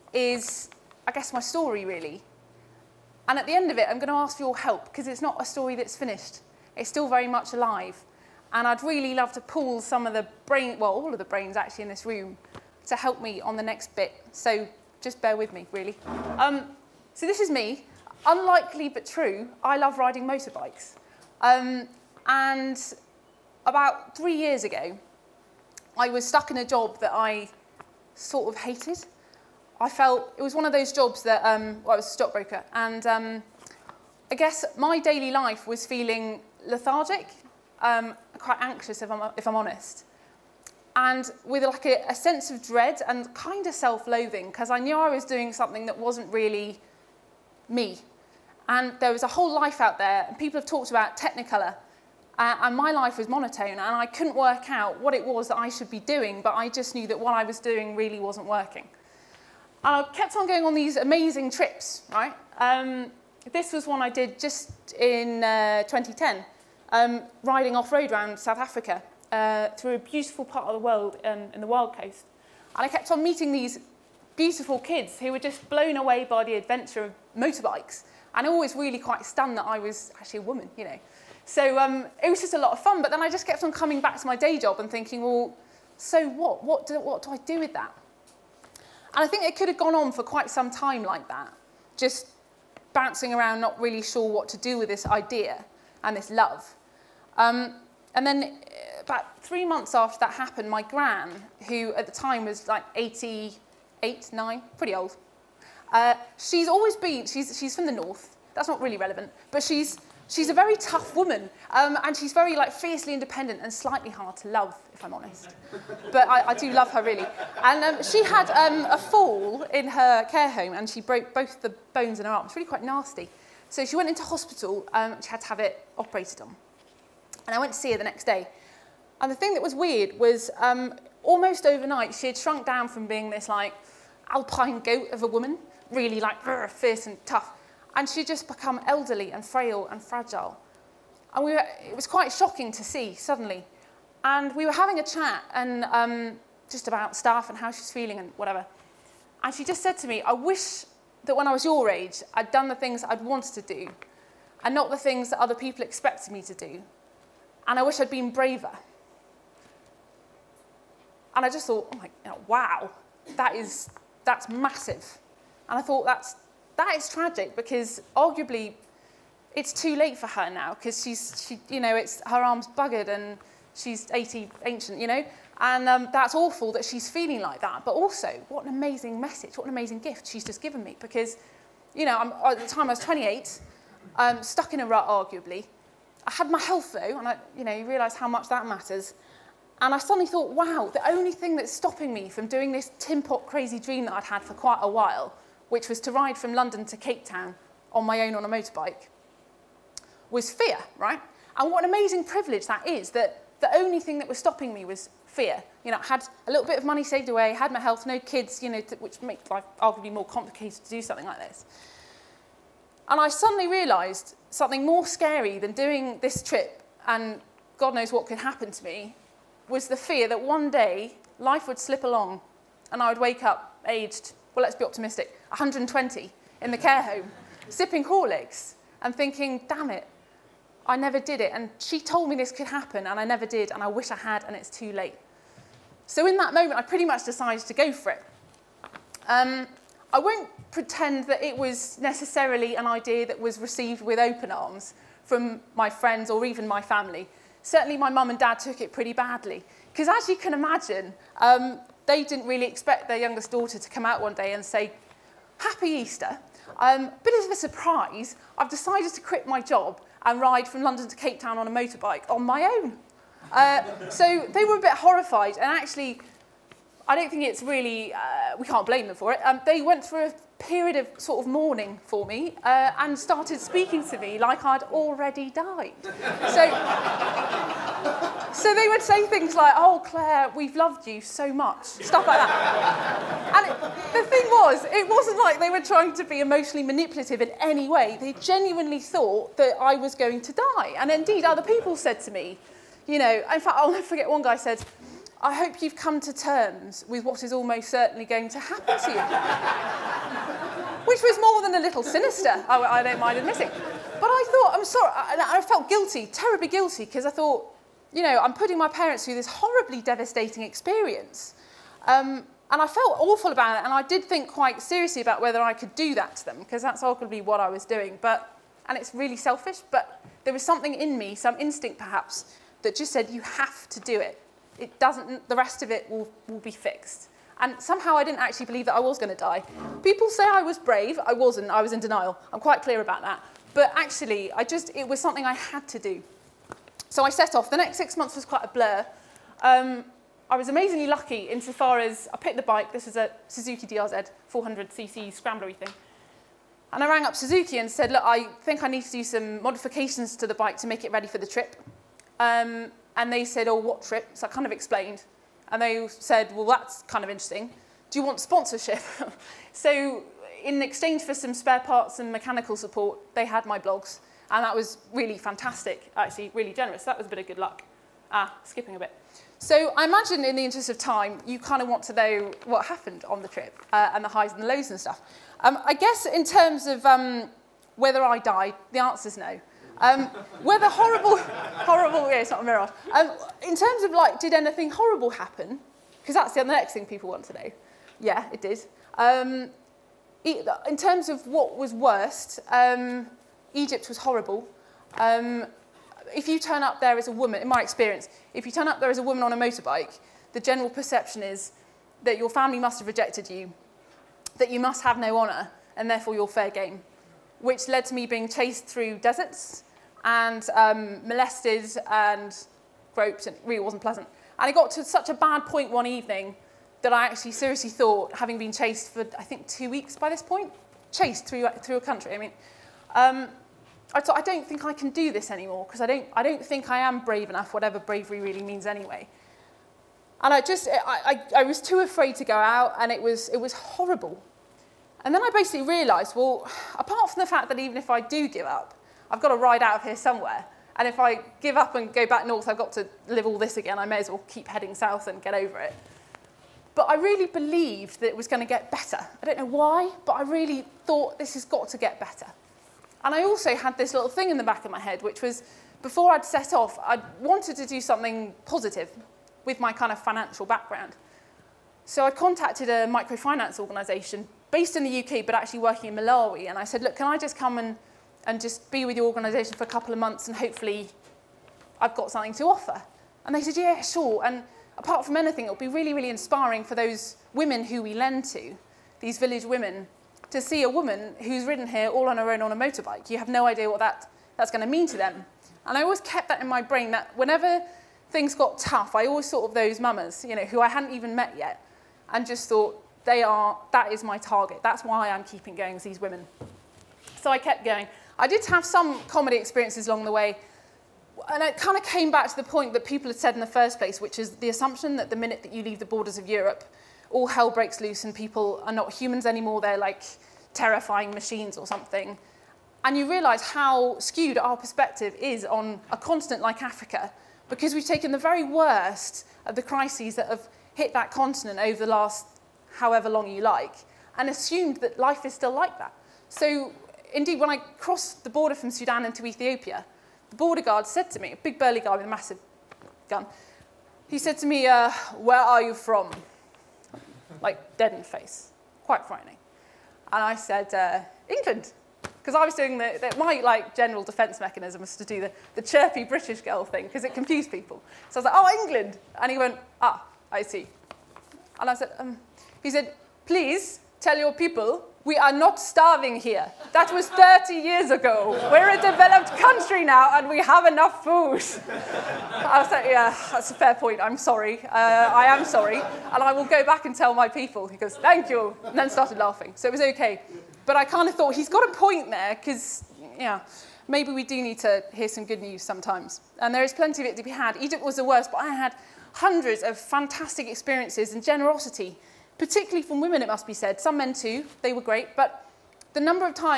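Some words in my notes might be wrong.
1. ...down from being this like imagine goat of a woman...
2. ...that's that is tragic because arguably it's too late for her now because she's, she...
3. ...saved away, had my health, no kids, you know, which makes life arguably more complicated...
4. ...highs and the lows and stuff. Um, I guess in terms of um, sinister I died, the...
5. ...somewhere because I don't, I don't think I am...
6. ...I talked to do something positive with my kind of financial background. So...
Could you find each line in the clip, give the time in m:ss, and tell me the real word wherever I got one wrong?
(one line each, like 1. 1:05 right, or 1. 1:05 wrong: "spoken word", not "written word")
1. 2:12 wrong: "alpine", not "imagine"
2. 2:46 right
3. 3:27 right
4. 6:14 wrong: "whether", not "sinister"
5. 7:05 wrong: "anymore", not "somewhere"
6. 7:37 wrong: "wanted", not "talked".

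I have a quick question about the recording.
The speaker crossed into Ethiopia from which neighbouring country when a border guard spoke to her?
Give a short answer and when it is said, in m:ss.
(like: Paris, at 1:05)
Sudan, at 8:48.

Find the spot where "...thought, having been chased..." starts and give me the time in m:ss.
6:57.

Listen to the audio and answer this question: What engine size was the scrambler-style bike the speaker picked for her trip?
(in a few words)
400cc.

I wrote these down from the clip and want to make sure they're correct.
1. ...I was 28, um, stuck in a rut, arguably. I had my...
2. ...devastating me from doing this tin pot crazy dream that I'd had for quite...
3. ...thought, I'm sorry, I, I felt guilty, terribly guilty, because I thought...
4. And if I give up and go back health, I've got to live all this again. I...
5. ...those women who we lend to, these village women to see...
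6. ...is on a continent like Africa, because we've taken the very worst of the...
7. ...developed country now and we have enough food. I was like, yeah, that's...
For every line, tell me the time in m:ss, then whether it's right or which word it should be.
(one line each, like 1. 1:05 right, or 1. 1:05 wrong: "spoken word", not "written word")
1. 3:02 right
2. 3:11 wrong: "stopping", not "devastating"
3. 5:04 right
4. 7:20 wrong: "north", not "health"
5. 7:56 right
6. 8:35 right
7. 9:18 right.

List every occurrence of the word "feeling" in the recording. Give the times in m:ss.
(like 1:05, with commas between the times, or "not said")
0:35, 2:27, 2:57.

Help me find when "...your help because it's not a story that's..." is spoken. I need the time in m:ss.
0:04.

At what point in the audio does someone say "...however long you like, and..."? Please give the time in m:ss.
8:42.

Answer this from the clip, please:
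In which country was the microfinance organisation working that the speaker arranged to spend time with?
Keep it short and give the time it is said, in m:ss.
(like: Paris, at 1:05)
Malawi, at 7:46.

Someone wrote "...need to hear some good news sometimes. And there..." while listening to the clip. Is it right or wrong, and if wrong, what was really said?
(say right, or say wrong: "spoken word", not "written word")
right.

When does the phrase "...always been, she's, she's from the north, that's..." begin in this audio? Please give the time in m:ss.
1:46.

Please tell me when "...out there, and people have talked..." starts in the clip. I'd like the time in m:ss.
0:49.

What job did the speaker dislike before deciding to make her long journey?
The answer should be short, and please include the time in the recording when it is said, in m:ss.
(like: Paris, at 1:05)
stockbroker, at 0:32.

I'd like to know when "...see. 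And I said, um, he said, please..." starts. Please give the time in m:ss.
9:10.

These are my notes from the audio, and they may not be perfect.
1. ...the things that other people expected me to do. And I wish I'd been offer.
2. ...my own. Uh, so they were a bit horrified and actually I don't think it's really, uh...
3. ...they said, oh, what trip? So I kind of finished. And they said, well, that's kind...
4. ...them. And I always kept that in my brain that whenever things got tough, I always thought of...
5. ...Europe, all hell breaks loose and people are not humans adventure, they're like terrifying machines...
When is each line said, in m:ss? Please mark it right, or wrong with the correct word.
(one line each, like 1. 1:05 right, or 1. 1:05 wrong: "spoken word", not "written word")
1. 2:34 wrong: "braver", not "offer"
2. 4:22 right
3. 5:53 wrong: "explained", not "finished"
4. 8:05 right
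5. 8:26 wrong: "anymore", not "adventure".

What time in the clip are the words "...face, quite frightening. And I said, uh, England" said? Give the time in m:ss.
8:58.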